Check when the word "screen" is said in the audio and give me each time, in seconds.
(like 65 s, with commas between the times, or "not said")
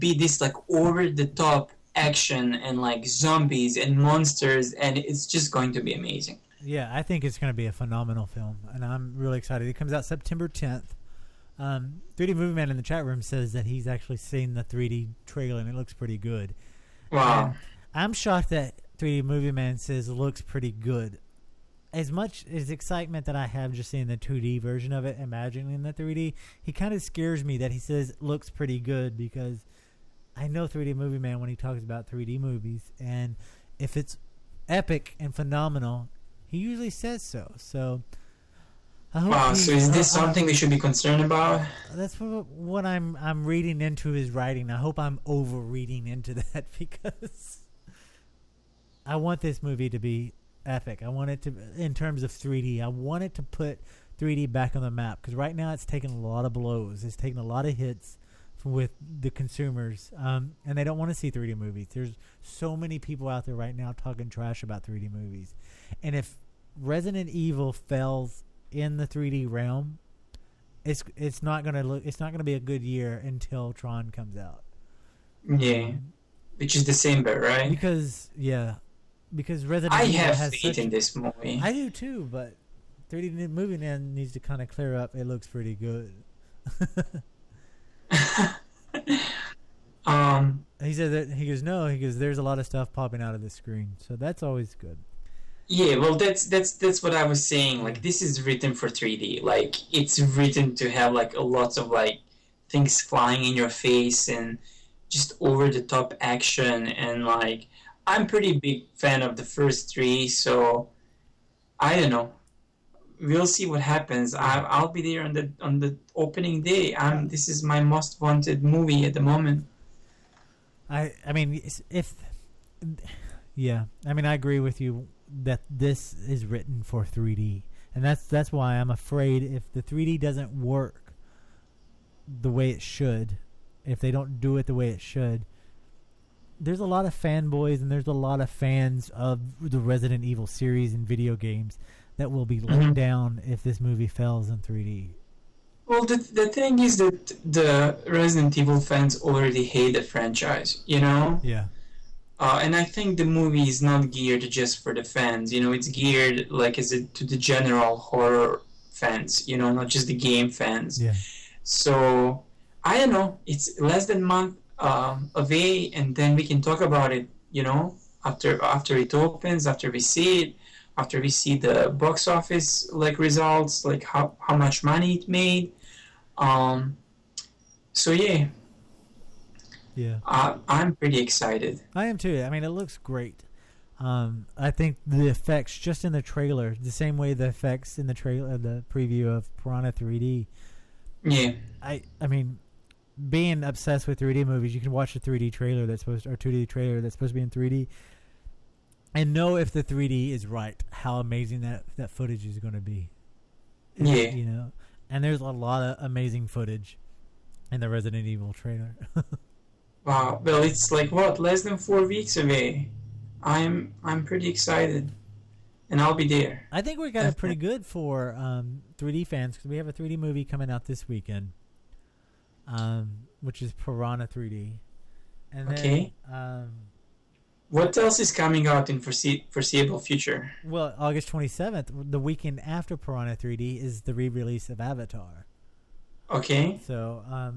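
93 s.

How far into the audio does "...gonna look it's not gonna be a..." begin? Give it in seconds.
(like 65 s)
71 s.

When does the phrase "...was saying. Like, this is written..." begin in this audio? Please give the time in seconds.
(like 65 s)
97 s.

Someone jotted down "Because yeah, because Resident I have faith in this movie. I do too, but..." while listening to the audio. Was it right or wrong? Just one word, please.
right.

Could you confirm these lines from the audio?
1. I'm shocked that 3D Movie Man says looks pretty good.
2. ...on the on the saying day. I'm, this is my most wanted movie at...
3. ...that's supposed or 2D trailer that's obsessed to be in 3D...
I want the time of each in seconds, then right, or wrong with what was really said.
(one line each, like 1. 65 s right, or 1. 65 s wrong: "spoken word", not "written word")
1. 17 s right
2. 115 s wrong: "opening", not "saying"
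3. 195 s wrong: "supposed", not "obsessed".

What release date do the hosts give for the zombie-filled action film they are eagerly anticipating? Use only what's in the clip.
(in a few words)
September 10th.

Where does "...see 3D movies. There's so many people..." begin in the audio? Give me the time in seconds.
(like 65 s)
61 s.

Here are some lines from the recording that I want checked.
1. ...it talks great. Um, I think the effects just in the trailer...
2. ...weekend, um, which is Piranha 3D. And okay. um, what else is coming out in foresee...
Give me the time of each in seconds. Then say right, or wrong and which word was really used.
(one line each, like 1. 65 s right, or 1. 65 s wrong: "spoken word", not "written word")
1. 182 s wrong: "looks", not "talks"
2. 221 s right.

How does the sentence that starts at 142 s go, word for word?
down if this movie fails in 3D.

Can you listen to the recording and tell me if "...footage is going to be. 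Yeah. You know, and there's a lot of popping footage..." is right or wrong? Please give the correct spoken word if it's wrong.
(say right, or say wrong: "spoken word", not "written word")
wrong: "amazing", not "popping".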